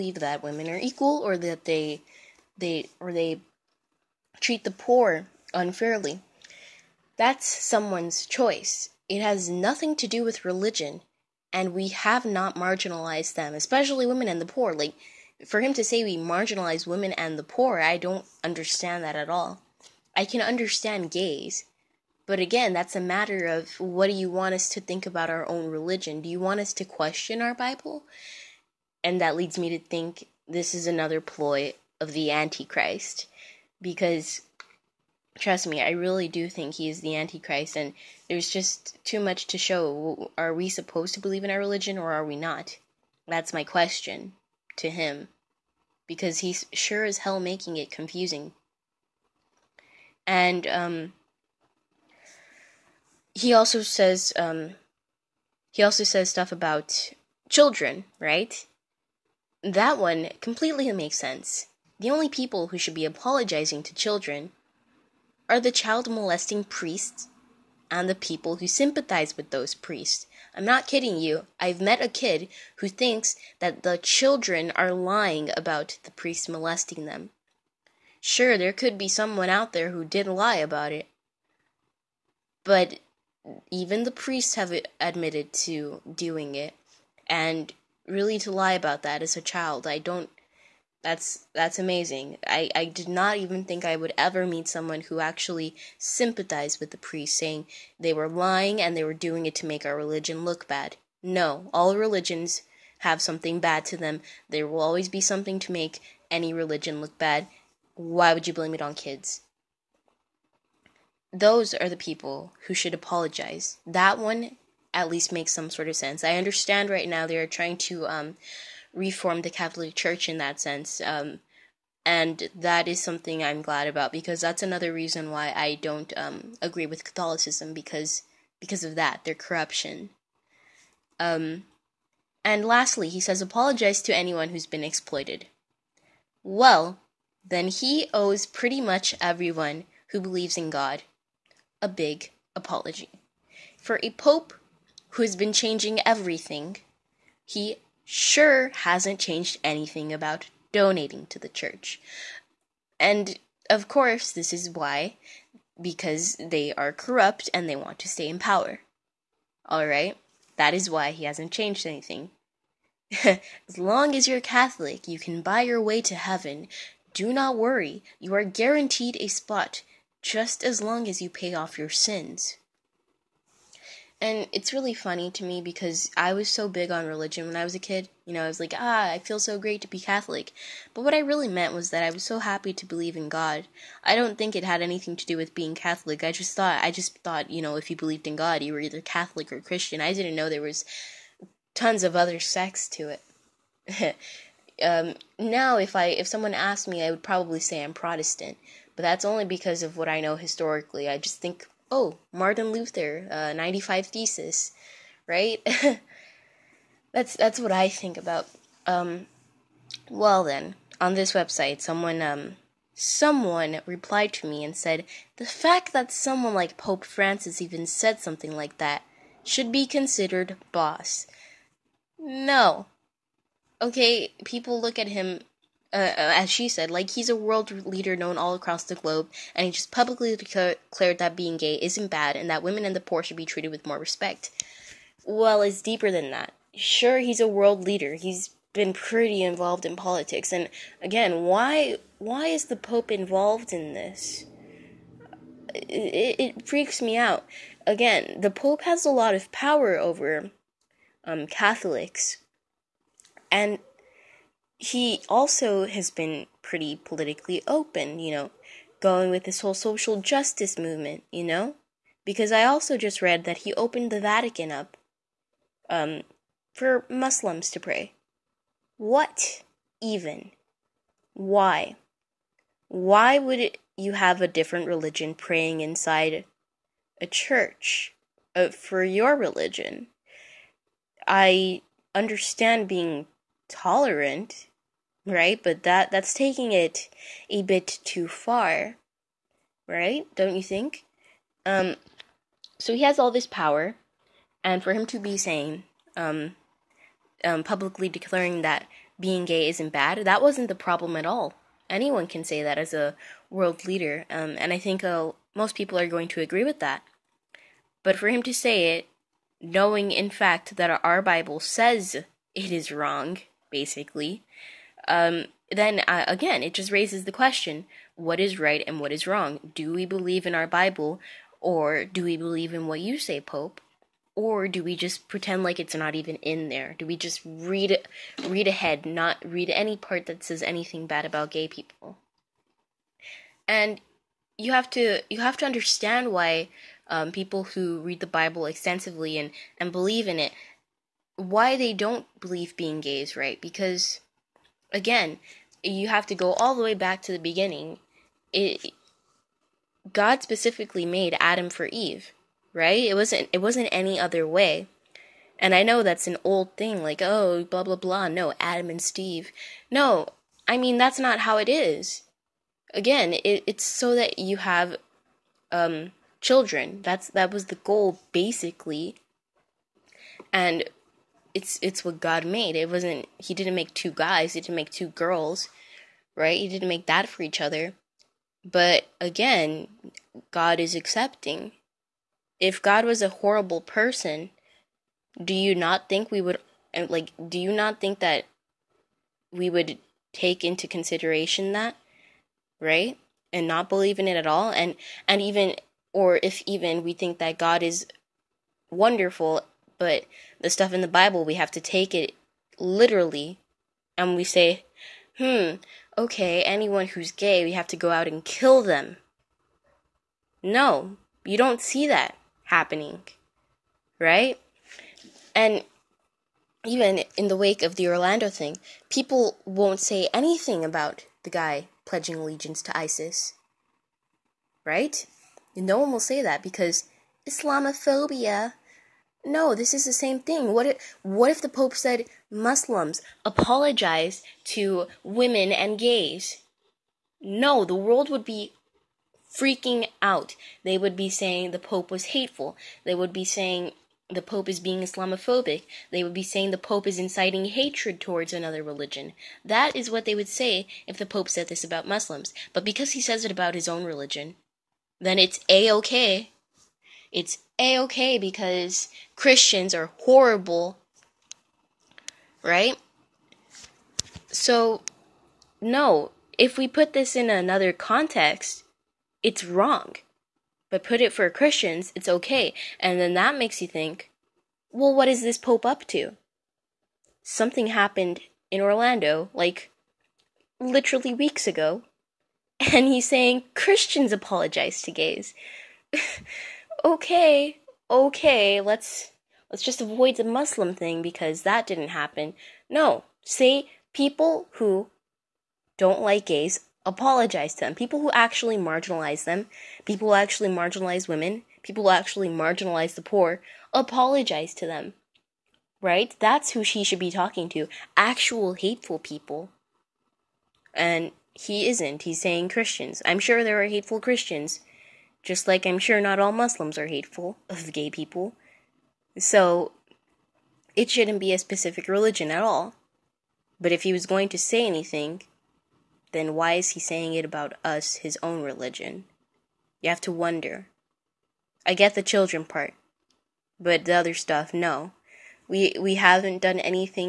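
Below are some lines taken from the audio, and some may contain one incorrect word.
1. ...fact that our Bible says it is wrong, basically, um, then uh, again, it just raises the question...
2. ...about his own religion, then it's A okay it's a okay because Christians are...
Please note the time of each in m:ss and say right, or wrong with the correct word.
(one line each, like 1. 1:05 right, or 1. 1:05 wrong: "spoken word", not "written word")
1. 5:10 right
2. 7:33 right.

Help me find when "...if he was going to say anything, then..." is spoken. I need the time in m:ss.
8:43.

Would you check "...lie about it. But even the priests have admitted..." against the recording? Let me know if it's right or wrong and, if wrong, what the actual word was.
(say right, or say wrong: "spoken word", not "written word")
right.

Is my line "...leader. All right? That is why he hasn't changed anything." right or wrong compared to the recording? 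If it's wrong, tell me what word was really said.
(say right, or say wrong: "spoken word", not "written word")
wrong: "power", not "leader".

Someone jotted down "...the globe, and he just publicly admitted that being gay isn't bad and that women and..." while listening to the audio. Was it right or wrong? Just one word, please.
wrong.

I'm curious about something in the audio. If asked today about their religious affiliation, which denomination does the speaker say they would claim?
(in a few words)
Protestant.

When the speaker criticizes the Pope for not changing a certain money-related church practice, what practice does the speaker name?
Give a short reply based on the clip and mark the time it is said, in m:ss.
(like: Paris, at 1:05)
donating to the church, at 2:30.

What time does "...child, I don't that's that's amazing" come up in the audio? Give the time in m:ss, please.
1:29.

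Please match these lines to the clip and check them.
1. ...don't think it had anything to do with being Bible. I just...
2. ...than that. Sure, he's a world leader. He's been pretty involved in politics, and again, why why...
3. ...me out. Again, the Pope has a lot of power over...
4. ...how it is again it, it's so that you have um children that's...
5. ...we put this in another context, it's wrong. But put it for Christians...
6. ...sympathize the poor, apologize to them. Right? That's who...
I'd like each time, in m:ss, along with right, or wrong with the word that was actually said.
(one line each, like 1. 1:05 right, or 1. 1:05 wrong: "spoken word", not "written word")
1. 3:04 wrong: "Catholic", not "Bible"
2. 3:56 right
3. 4:06 right
4. 6:01 right
5. 7:46 right
6. 8:22 wrong: "marginalize", not "sympathize".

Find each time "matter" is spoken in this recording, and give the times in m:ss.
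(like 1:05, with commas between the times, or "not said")
0:22.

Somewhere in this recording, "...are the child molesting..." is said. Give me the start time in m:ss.
1:05.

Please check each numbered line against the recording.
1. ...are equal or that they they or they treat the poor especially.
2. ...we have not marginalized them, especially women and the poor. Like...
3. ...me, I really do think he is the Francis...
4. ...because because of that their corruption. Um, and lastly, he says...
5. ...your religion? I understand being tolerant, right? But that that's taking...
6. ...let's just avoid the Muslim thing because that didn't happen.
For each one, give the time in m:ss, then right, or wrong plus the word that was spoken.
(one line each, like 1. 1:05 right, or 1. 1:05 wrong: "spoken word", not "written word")
1. 0:00 wrong: "unfairly", not "especially"
2. 0:11 right
3. 0:35 wrong: "Antichrist", not "Francis"
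4. 2:07 right
5. 4:39 right
6. 8:09 right.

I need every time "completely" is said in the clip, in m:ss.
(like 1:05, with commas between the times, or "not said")
1:00.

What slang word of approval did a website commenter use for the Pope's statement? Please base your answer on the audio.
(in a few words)
boss.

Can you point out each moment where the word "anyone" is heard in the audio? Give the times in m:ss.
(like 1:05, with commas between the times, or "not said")
2:14, 5:01, 6:46.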